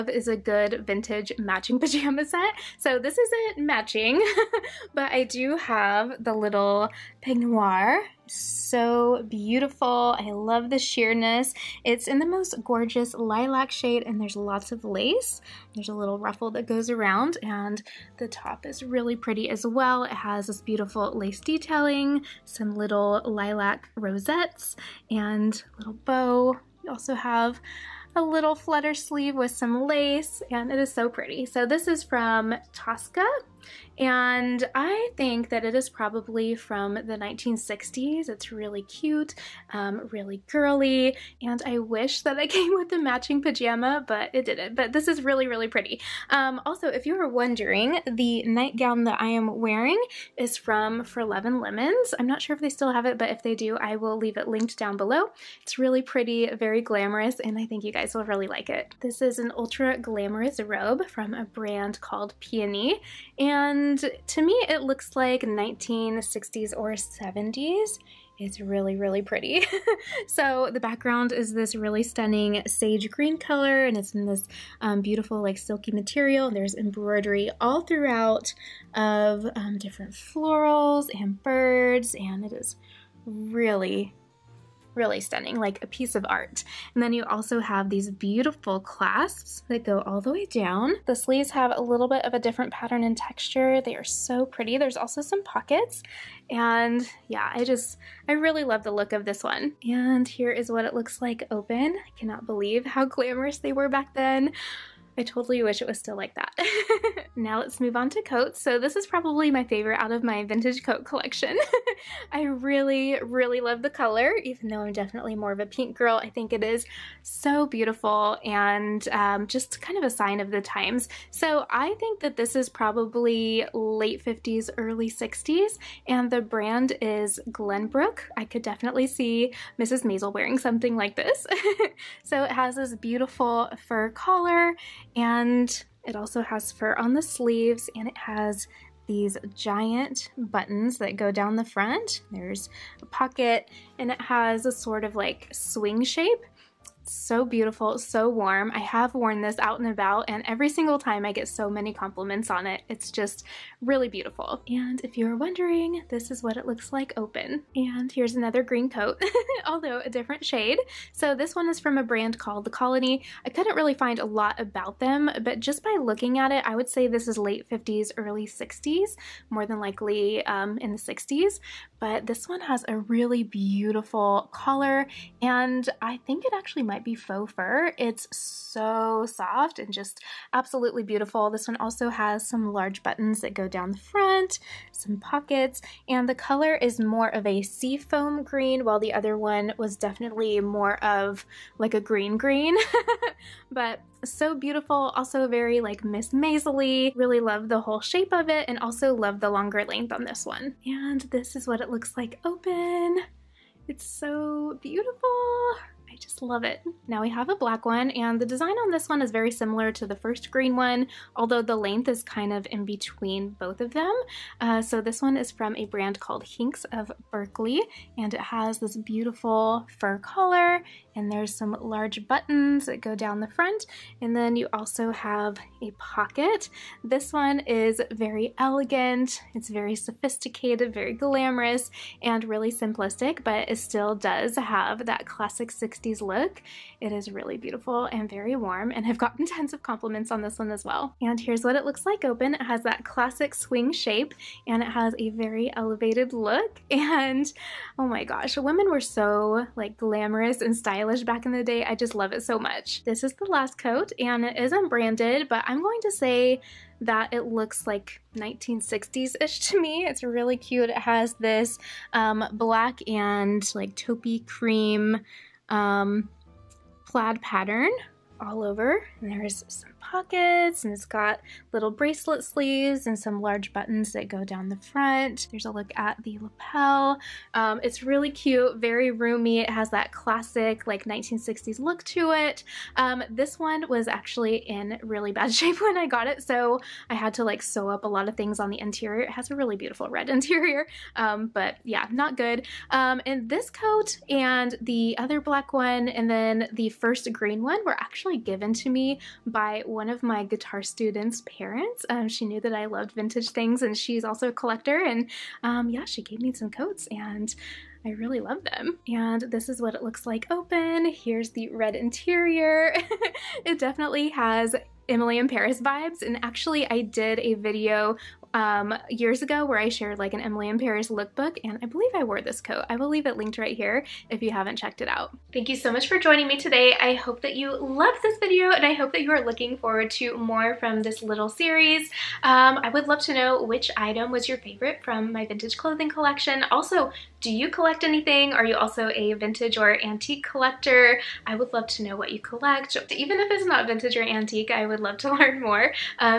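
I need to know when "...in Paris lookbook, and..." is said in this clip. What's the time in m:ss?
5:20.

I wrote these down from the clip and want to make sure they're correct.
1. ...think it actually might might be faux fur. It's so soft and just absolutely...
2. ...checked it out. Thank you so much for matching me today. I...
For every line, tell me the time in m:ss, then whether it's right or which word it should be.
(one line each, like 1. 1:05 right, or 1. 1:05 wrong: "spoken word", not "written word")
1. 2:56 right
2. 5:24 wrong: "joining", not "matching".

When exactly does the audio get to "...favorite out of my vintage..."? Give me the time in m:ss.
1:49.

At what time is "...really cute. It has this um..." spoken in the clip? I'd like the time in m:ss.
4:20.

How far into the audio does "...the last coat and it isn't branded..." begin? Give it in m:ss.
4:13.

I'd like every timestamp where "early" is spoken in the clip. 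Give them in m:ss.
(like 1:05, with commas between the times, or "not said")
2:04, 2:48.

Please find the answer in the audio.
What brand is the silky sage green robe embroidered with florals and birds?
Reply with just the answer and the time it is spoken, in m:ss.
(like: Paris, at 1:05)
Peony, at 1:02.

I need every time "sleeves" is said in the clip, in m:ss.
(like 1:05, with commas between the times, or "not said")
0:28, 1:31, 2:17, 4:32.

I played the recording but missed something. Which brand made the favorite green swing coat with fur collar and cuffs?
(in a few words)
Glenbrook.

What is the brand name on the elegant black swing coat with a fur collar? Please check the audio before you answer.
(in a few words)
Hinks of Berkeley.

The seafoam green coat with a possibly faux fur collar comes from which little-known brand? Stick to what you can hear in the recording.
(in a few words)
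The Colony.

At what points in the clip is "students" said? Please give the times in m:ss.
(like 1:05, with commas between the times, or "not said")
5:00.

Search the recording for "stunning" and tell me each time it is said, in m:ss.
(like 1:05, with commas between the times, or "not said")
1:12, 1:25.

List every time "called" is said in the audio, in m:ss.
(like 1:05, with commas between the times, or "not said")
1:02, 2:42, 3:36.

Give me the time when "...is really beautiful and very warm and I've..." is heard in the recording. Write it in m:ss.
3:57.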